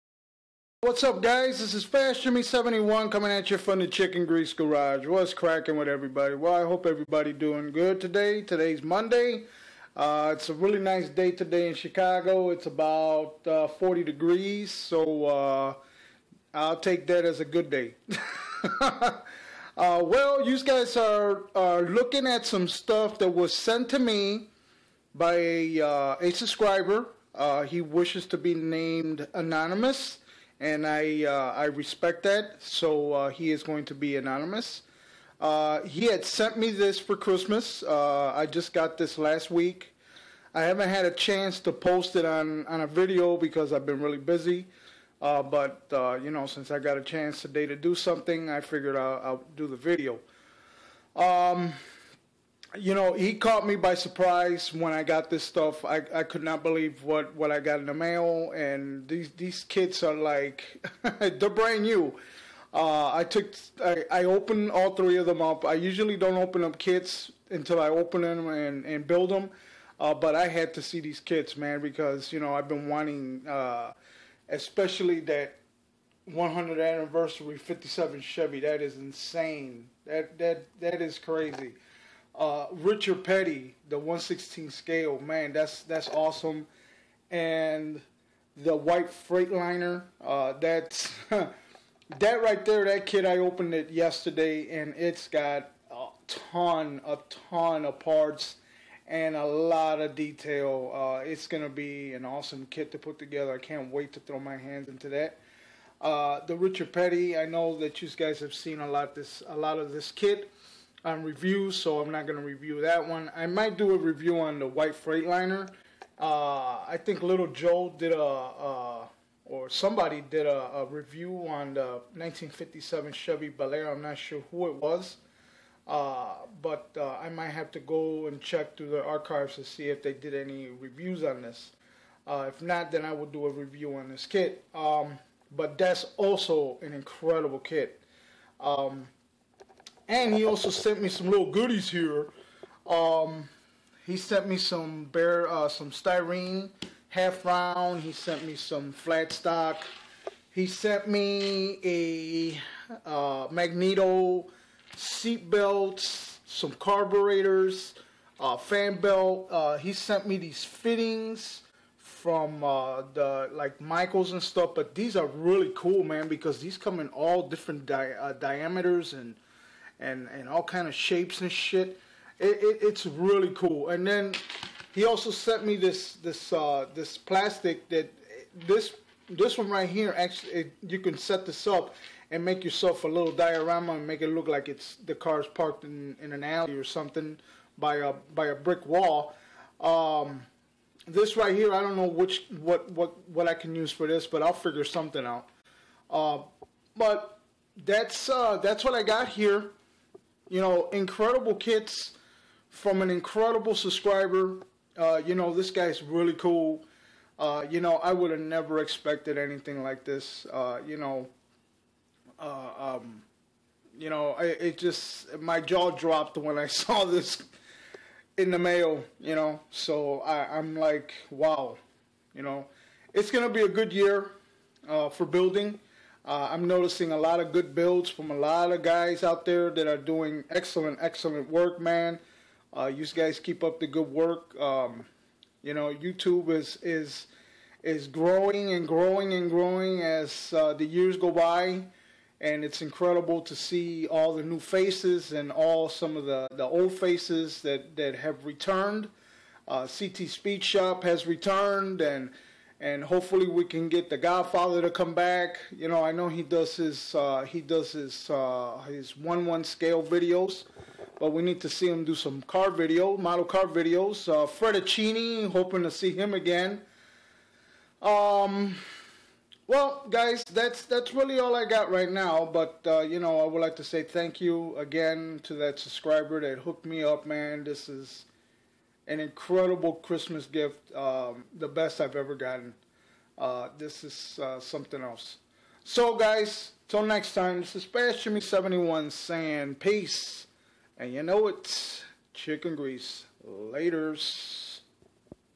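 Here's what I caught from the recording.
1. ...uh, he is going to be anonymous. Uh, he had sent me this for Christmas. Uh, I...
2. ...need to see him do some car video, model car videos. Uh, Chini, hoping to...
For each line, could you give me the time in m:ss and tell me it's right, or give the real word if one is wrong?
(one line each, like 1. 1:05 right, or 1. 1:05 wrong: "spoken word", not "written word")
1. 0:33 right
2. 4:21 right.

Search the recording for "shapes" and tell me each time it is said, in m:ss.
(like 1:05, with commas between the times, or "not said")
2:50.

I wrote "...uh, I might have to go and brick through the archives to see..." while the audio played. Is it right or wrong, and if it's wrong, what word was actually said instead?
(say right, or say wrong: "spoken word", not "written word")
wrong: "check", not "brick".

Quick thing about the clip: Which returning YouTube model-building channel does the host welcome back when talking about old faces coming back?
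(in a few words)
CT Speed Shop.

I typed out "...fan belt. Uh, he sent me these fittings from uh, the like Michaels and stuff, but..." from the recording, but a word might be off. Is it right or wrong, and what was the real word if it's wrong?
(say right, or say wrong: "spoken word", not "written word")
right.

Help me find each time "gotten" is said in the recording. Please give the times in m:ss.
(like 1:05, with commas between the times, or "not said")
4:42.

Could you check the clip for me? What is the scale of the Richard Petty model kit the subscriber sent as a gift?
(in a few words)
1/16.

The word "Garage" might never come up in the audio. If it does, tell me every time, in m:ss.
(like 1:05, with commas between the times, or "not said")
0:04.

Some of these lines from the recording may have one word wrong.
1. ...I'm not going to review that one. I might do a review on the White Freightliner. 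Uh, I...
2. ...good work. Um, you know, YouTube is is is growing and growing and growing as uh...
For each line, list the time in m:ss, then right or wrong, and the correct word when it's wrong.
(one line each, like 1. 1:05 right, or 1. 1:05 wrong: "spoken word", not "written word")
1. 1:51 right
2. 3:53 right.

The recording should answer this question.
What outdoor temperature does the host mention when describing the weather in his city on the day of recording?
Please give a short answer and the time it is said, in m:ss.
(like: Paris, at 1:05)
40 degrees, at 0:13.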